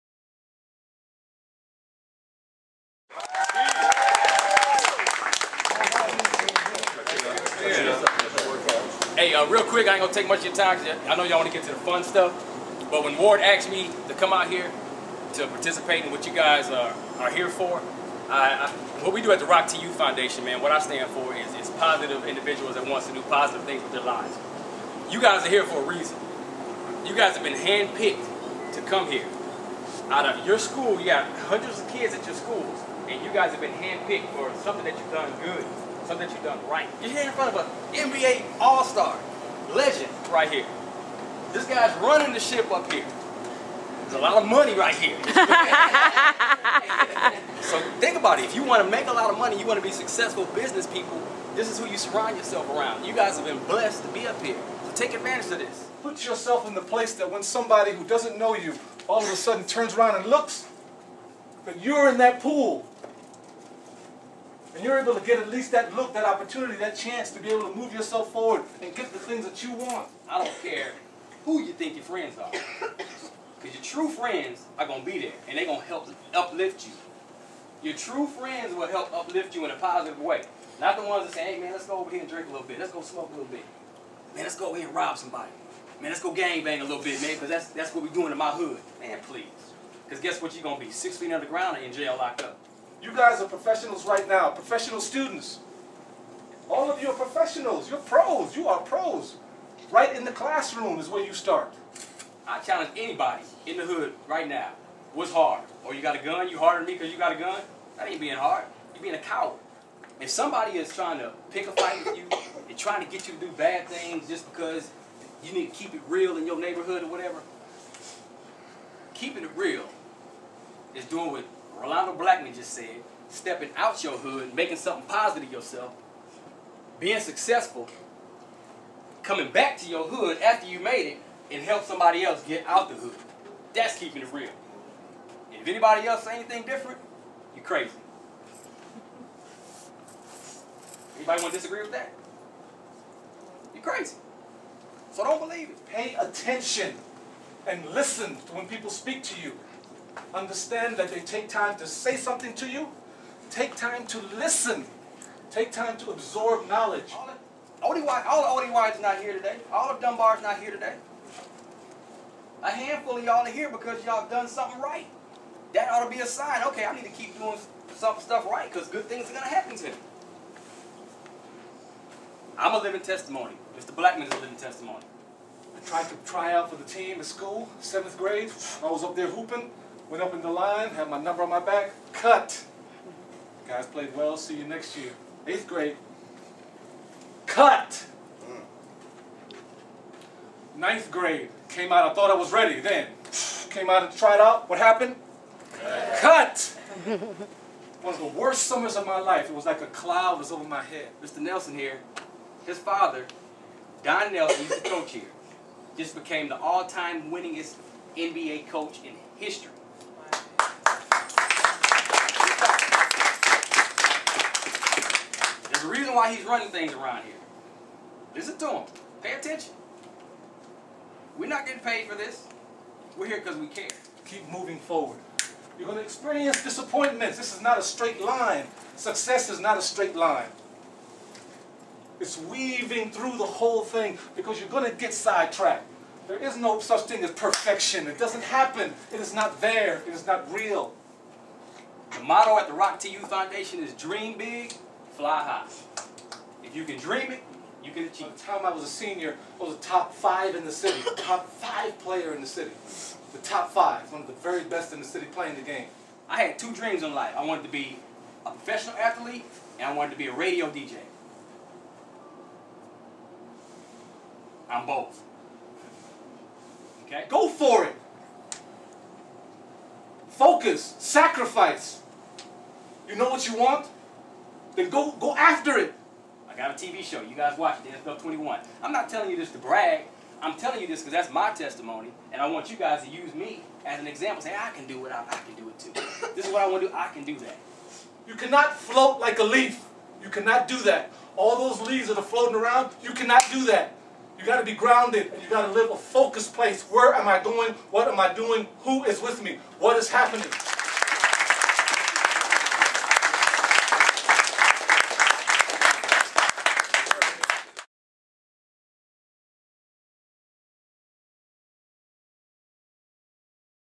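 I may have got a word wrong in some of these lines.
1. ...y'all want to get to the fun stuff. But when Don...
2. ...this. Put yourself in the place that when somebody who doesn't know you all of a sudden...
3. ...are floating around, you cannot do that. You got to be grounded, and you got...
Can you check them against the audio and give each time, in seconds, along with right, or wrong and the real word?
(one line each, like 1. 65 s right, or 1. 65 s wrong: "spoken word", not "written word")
1. 11 s wrong: "Ward", not "Don"
2. 55 s right
3. 292 s right.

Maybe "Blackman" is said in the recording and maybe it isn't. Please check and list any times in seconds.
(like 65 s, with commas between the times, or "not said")
122 s, 173 s.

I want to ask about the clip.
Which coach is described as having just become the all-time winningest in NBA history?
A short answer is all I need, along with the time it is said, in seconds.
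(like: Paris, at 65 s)
Don Nelson, at 204 s.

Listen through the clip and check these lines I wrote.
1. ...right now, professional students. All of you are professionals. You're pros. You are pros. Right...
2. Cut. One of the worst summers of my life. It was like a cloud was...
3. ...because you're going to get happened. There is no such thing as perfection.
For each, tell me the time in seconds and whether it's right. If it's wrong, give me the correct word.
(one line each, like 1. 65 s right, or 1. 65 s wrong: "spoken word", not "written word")
1. 94 s right
2. 196 s right
3. 234 s wrong: "sidetracked", not "happened".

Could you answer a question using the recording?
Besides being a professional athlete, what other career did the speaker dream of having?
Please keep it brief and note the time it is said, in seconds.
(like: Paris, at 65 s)
Radio DJ, at 260 s.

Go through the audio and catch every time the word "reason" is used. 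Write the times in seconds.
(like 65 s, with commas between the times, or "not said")
25 s, 215 s.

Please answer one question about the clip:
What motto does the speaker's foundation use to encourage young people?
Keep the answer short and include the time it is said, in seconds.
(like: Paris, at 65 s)
Dream big, fly high, at 243 s.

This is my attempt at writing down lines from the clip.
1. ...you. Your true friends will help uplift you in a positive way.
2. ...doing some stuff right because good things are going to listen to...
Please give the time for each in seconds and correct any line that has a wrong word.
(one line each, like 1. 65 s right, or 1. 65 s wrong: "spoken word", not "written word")
1. 76 s right
2. 167 s wrong: "happen", not "listen".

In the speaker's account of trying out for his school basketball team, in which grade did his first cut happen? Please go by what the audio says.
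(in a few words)
Seventh grade.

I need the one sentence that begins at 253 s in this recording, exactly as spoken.
The top five, one of the very best in the city playing the game.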